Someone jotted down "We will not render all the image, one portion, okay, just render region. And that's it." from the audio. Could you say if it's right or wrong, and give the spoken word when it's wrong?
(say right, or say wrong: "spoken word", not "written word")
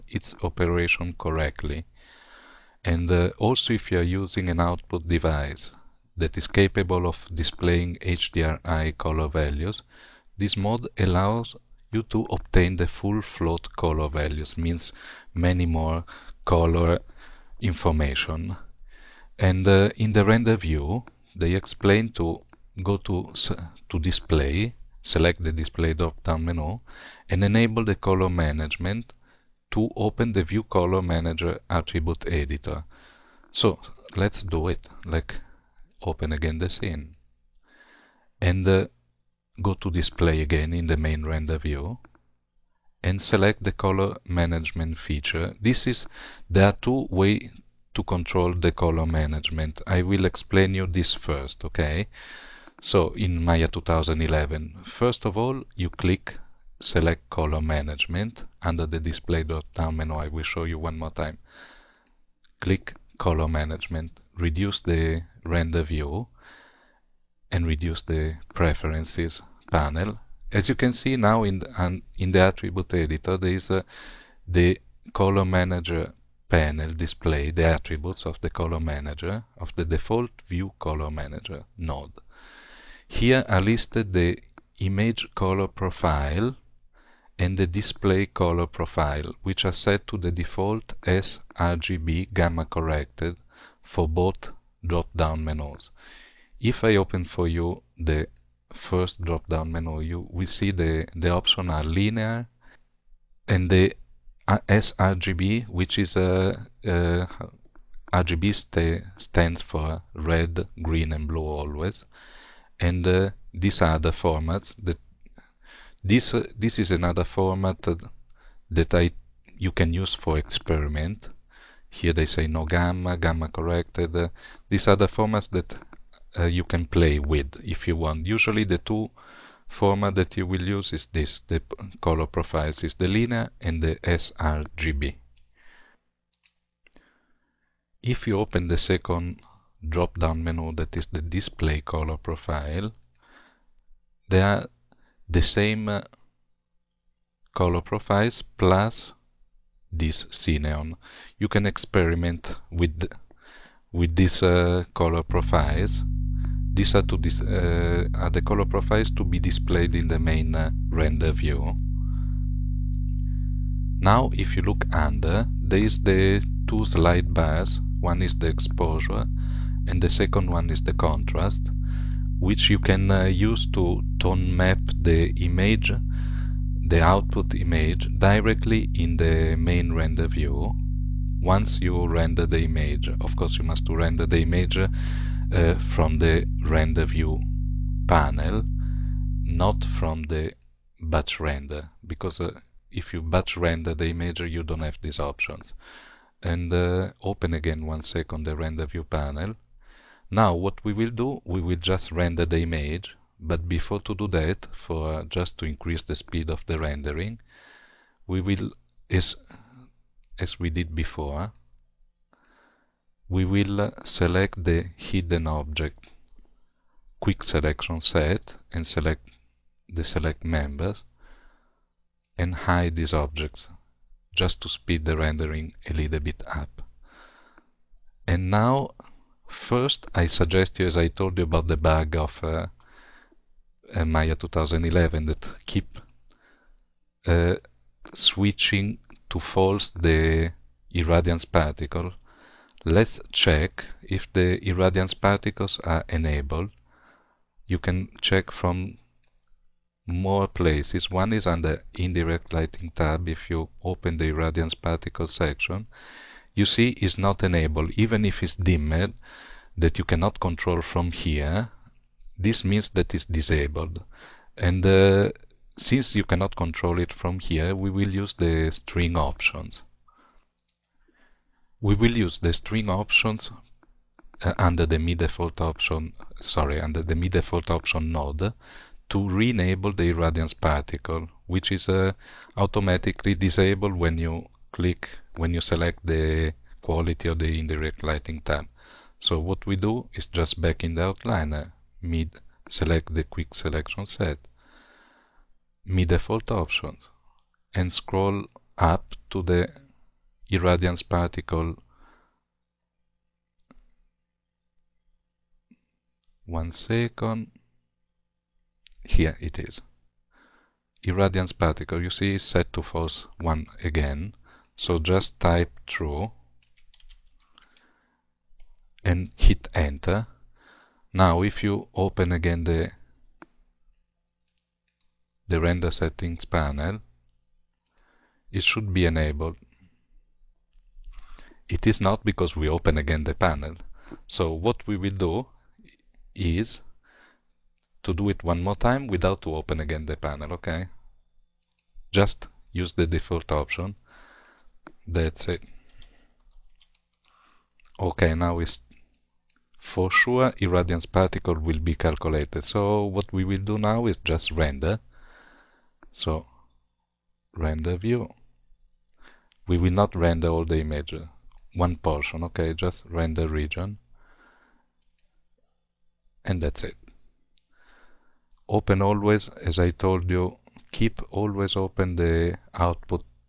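right.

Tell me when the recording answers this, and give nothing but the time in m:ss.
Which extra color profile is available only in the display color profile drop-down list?
2:30.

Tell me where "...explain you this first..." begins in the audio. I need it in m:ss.
0:50.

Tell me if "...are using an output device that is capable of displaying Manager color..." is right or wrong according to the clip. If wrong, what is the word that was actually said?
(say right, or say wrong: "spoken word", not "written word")
wrong: "HDRI", not "Manager".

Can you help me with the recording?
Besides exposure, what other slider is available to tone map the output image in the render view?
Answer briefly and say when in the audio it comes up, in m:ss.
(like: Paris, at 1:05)
contrast, at 2:50.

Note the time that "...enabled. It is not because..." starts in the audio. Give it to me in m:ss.
5:29.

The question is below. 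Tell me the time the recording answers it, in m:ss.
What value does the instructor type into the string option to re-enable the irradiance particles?
5:15.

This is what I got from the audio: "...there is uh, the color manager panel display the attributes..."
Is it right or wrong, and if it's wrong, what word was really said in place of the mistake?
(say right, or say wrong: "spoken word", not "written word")
right.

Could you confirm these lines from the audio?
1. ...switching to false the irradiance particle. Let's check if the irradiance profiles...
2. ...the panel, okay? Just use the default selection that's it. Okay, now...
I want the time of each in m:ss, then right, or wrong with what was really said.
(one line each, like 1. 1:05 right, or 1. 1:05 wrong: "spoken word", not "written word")
1. 3:58 wrong: "particles", not "profiles"
2. 5:40 wrong: "option", not "selection".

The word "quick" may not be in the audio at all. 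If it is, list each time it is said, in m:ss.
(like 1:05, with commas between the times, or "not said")
3:37, 4:53.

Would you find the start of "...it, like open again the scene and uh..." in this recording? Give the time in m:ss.
0:34.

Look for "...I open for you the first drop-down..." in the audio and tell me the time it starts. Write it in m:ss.
1:36.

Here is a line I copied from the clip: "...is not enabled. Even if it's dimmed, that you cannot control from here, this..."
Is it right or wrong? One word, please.
right.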